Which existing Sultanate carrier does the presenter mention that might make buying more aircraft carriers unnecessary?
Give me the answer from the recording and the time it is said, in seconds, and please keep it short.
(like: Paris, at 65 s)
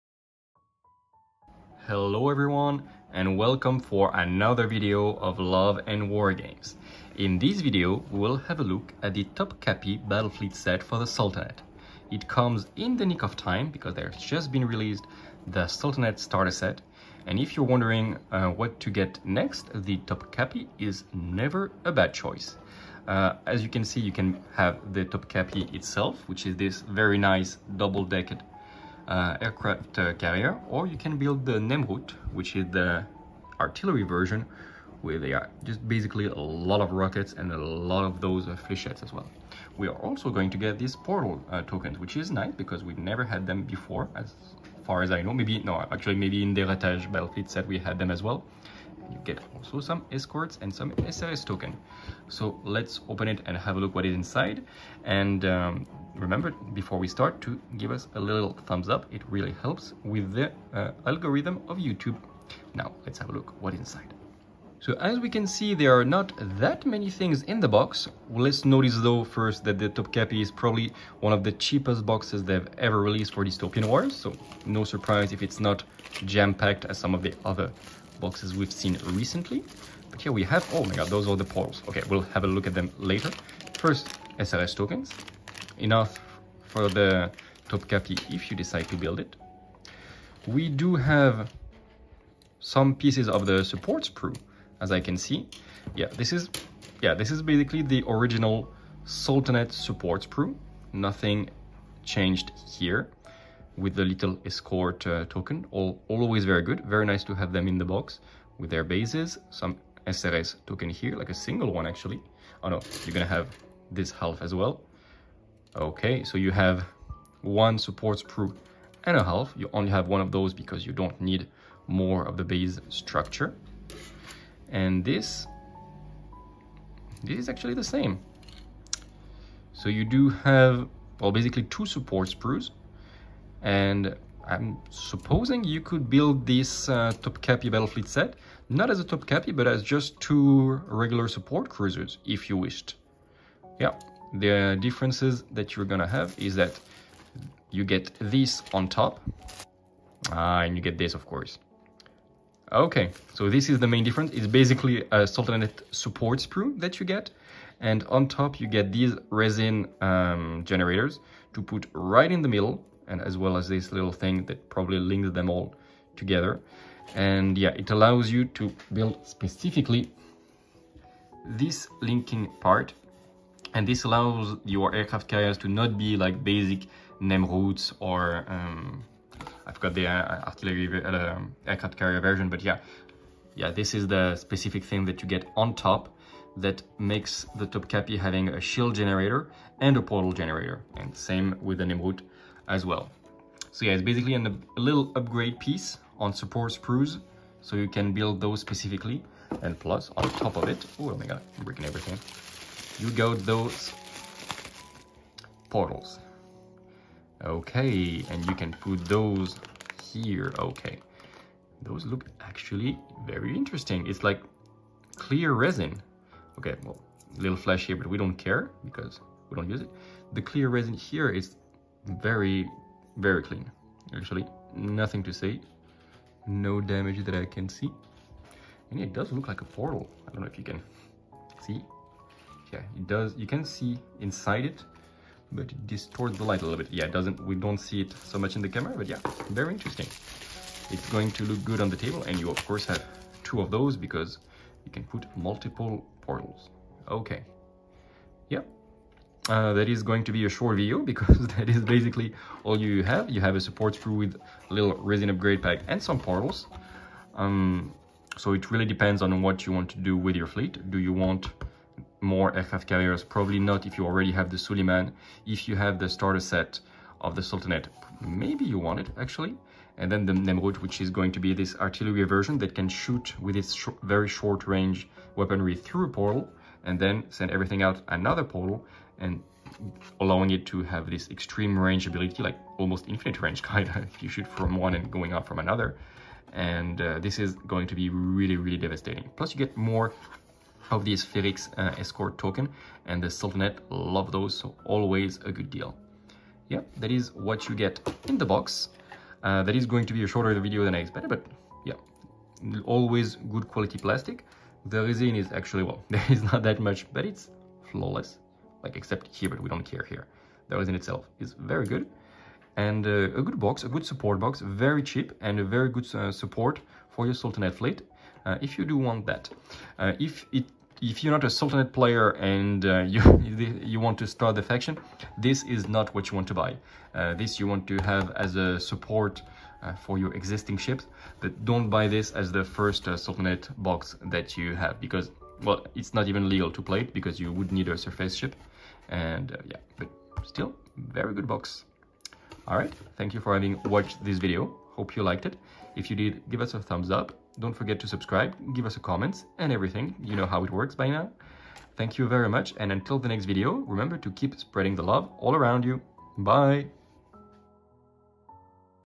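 Suleiman, at 264 s.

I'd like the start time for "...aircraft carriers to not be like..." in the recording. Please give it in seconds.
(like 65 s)
174 s.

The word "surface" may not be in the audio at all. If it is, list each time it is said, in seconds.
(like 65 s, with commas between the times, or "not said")
337 s.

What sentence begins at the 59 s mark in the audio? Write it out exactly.
It really helps with the uh, algorithm of YouTube.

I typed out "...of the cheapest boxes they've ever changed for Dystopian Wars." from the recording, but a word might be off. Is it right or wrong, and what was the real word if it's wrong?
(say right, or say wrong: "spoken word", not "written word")
wrong: "released", not "changed".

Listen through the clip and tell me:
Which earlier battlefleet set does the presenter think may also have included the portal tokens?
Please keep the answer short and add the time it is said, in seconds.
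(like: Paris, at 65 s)
Ratage, at 46 s.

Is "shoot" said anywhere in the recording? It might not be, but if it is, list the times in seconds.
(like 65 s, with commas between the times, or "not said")
272 s, 284 s.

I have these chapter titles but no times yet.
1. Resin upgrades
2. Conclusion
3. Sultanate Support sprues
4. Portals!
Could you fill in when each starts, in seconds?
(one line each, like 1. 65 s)
1. 148 s
2. 295 s
3. 88 s
4. 202 s.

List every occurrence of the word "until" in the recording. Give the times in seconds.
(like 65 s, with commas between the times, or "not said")
352 s.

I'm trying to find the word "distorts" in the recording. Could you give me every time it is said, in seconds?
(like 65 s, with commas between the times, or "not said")
235 s.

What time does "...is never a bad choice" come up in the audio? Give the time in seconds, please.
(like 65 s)
20 s.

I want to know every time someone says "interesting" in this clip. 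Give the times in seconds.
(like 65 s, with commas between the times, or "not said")
213 s, 239 s.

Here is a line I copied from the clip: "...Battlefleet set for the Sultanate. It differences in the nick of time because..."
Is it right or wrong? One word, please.
wrong.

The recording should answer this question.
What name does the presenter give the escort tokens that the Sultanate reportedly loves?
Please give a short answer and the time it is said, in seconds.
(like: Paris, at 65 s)
Felix, at 291 s.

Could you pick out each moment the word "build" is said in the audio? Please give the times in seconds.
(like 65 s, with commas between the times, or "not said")
31 s, 88 s, 136 s, 168 s, 198 s.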